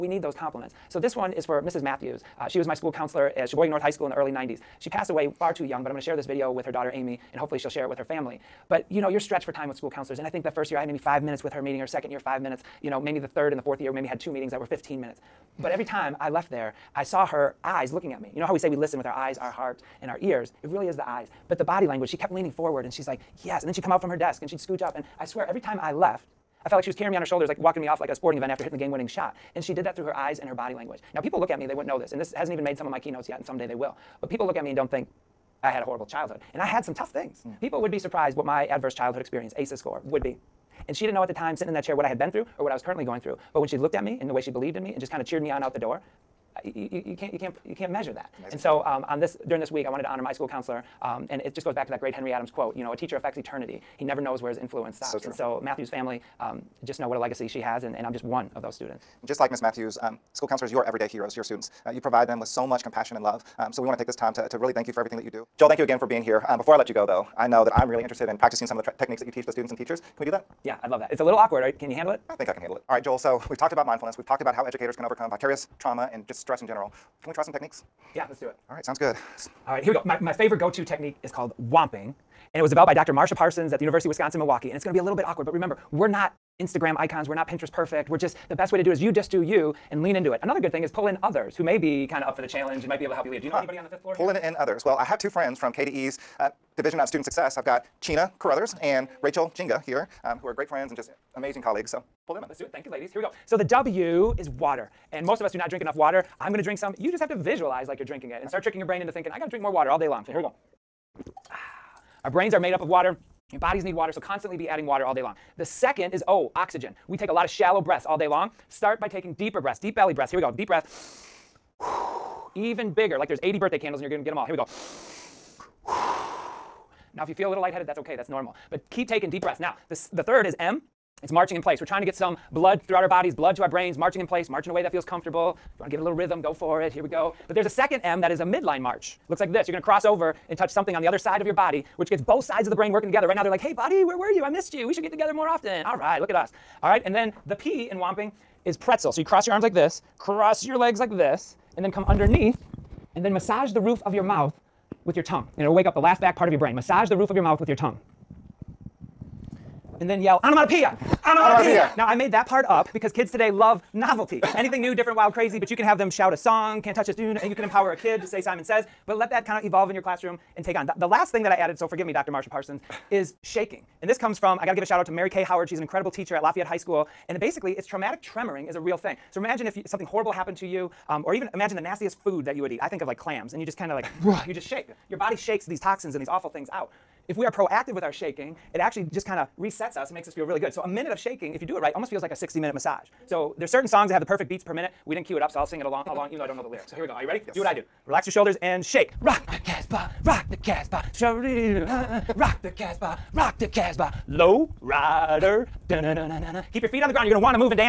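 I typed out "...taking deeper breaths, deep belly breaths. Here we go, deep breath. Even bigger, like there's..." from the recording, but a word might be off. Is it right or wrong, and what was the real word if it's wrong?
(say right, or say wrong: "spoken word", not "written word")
right.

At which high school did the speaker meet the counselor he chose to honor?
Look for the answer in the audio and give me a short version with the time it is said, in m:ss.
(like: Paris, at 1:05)
Sheboygan North High School, at 0:03.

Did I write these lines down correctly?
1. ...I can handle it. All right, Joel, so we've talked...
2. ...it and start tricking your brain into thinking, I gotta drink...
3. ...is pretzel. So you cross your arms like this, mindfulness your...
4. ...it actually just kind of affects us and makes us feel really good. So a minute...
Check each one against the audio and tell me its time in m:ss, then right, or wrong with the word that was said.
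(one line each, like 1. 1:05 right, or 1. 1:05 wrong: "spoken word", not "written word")
1. 1:12 right
2. 1:48 right
3. 2:28 wrong: "cross", not "mindfulness"
4. 3:08 wrong: "resets", not "affects".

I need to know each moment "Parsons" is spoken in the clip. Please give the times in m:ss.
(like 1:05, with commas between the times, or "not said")
1:23, 2:52.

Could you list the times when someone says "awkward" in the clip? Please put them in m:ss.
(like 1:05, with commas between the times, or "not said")
1:11, 1:25.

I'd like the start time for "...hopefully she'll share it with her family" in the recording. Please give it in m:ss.
0:07.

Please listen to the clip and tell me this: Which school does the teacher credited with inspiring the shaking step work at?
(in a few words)
Lafayette High School.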